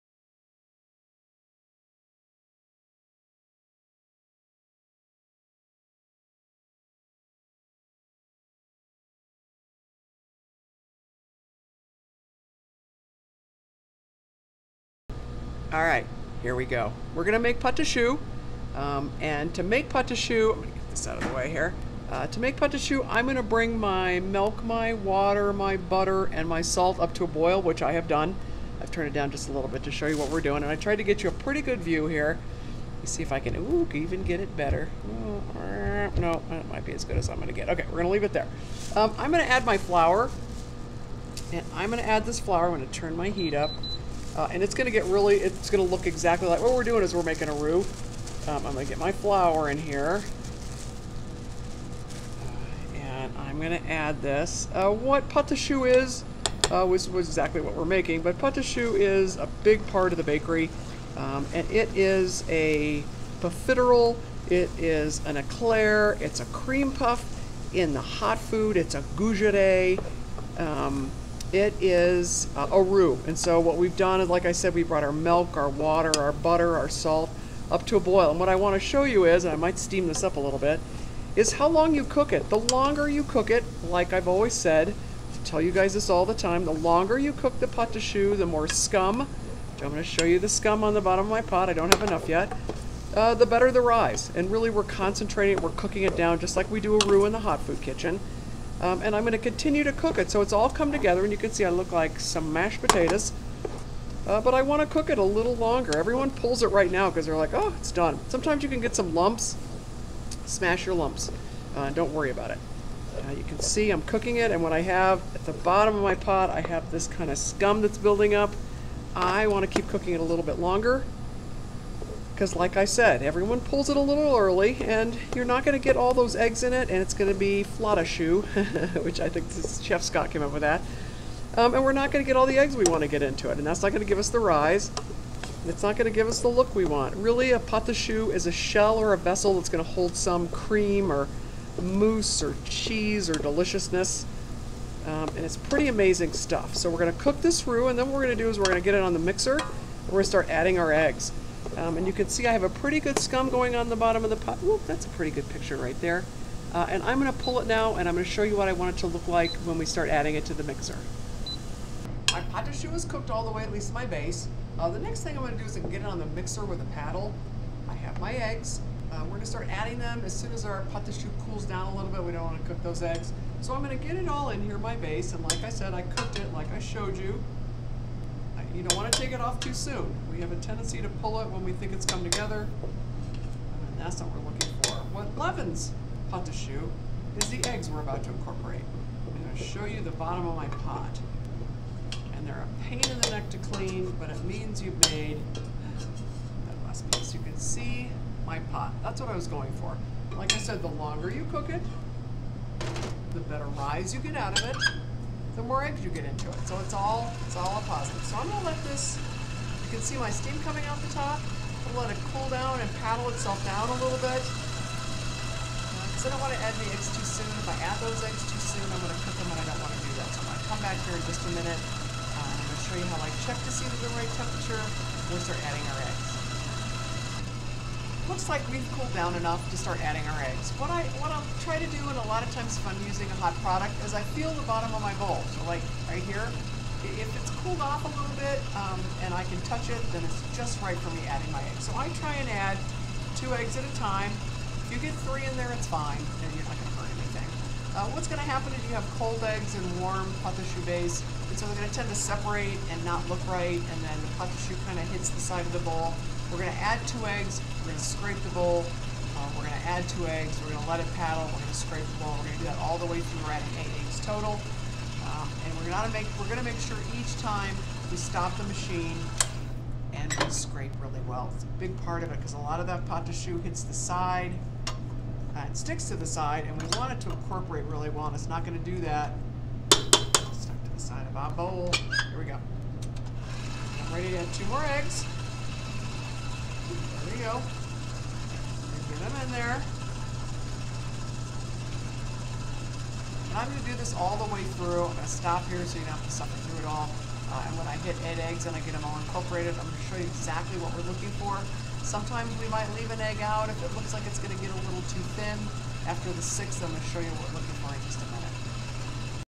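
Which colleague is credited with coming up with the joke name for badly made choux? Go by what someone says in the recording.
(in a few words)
Chef Scott.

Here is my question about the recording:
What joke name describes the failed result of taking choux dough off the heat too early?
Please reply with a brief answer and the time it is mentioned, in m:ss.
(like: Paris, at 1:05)
flottashoe, at 2:07.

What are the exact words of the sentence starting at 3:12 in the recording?
And they're a pain in the neck to clean, but it means you've made that last piece.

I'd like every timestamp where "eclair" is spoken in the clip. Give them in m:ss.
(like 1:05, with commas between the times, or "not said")
1:05.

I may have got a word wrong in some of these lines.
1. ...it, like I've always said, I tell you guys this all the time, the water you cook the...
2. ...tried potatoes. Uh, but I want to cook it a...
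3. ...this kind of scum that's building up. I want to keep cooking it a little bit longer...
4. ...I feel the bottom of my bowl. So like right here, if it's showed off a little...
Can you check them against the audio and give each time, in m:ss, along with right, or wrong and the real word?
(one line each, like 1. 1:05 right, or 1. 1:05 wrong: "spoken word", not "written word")
1. 1:23 wrong: "longer", not "water"
2. 1:42 wrong: "mashed", not "tried"
3. 1:56 right
4. 3:54 wrong: "cooled", not "showed".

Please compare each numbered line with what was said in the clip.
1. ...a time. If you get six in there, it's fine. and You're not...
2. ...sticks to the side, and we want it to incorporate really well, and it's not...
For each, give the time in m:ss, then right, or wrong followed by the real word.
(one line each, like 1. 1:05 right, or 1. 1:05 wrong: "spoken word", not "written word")
1. 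4:03 wrong: "three", not "six"
2. 4:35 right.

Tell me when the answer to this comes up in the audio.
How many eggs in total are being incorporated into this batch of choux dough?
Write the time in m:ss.
4:23.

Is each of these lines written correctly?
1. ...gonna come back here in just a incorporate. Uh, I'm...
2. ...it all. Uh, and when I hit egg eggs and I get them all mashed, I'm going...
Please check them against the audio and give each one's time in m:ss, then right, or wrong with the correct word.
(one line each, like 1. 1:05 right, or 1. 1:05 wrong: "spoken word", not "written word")
1. 3:40 wrong: "minute", not "incorporate"
2. 4:56 wrong: "incorporated", not "mashed".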